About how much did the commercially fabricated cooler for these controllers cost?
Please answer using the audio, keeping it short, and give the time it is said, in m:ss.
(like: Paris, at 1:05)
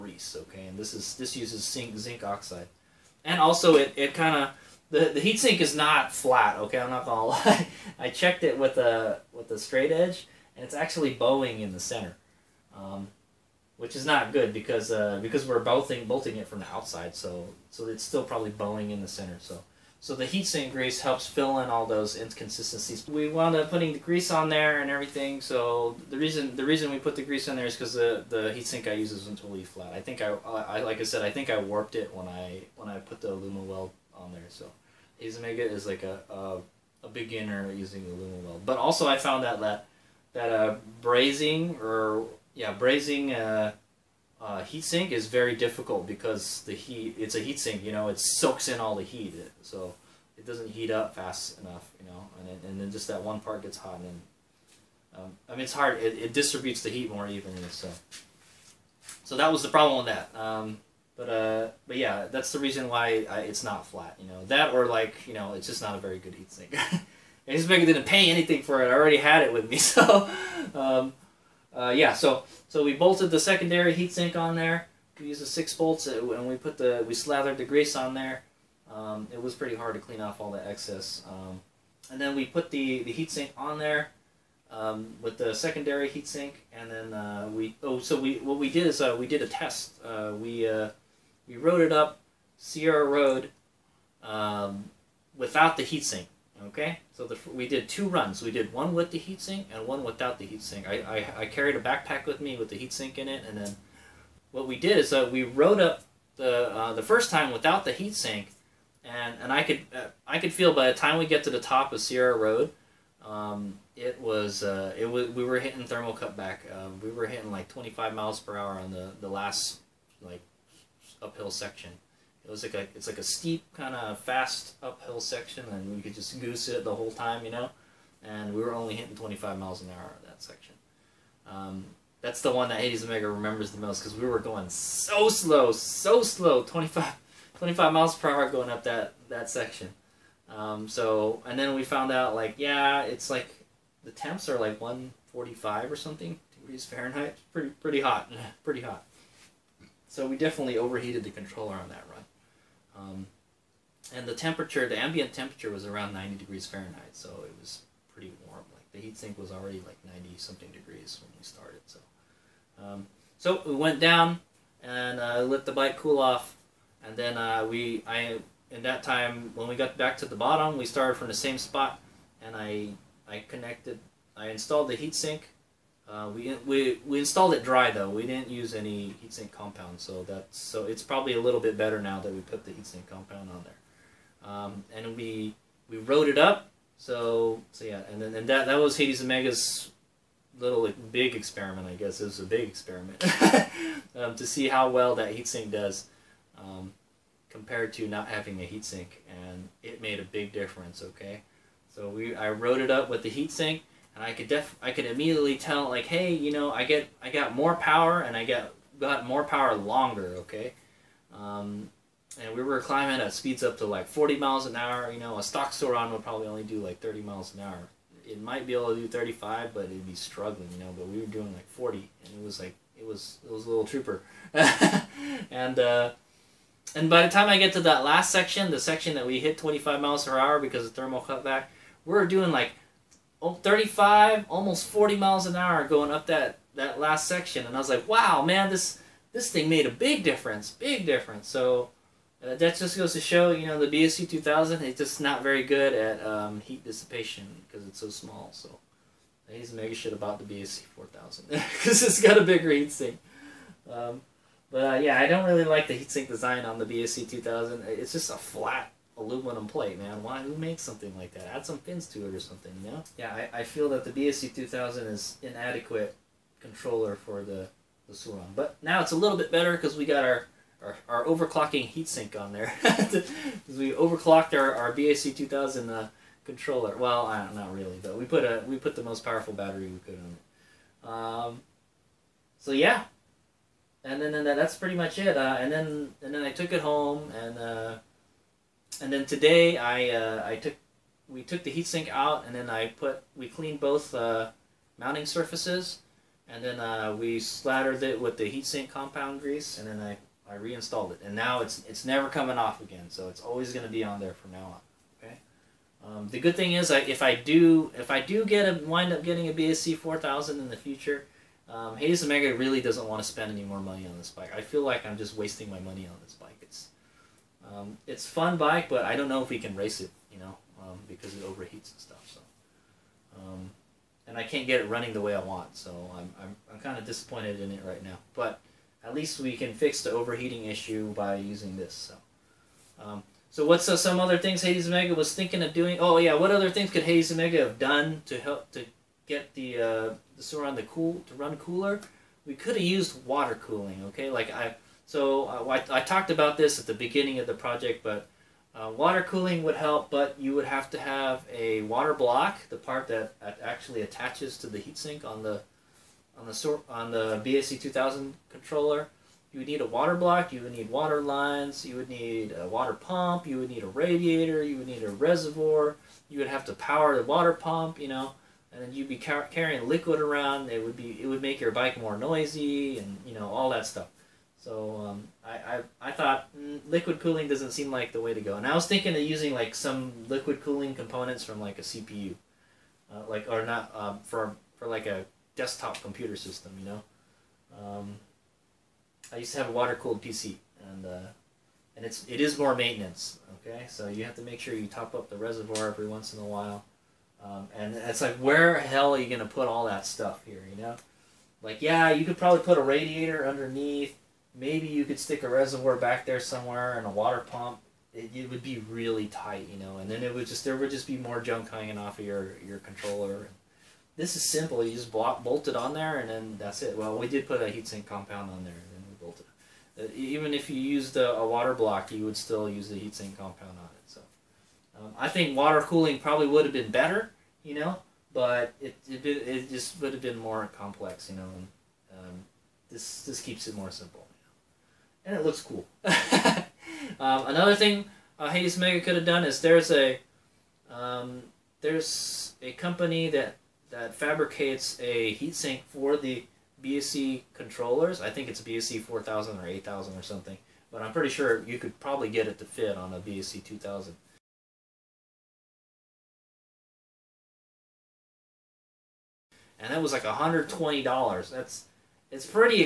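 $120, at 7:40.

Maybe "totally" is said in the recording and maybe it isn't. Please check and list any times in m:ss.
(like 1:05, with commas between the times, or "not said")
0:29.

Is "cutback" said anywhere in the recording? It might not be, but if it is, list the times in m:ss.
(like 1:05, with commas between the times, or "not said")
1:56, 3:51.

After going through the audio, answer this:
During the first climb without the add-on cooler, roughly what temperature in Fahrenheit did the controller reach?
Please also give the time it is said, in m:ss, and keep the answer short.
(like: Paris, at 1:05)
145, at 2:24.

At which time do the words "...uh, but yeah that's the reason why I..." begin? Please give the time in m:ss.
1:01.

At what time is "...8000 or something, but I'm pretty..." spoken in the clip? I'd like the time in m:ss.
7:29.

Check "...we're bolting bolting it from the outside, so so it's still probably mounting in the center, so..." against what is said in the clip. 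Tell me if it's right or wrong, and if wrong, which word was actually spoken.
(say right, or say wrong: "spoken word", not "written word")
wrong: "bowing", not "mounting".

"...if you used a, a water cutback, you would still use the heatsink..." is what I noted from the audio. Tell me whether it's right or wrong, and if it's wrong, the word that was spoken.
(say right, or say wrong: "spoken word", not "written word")
wrong: "block", not "cutback".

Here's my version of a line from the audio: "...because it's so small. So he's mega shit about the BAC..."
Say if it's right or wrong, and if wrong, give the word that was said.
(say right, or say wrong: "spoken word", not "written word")
right.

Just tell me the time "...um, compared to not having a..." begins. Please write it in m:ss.
3:16.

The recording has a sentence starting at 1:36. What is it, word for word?
Okay, so the, we did two runs.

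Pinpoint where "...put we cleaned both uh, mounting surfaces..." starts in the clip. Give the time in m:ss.
4:52.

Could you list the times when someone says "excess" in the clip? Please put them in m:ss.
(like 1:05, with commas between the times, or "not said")
1:20.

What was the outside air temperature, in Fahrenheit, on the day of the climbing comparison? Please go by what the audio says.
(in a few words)
90 degrees.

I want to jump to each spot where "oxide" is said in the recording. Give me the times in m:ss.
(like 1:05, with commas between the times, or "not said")
0:02.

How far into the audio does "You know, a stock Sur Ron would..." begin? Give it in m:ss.
3:35.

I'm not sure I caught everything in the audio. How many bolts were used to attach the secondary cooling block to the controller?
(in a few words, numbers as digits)
6.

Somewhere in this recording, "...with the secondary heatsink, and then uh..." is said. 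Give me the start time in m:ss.
1:25.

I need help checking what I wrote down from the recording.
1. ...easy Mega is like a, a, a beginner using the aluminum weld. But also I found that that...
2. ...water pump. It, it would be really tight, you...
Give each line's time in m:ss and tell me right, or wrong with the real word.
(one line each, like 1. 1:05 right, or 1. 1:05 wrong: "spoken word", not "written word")
1. 0:35 right
2. 6:47 right.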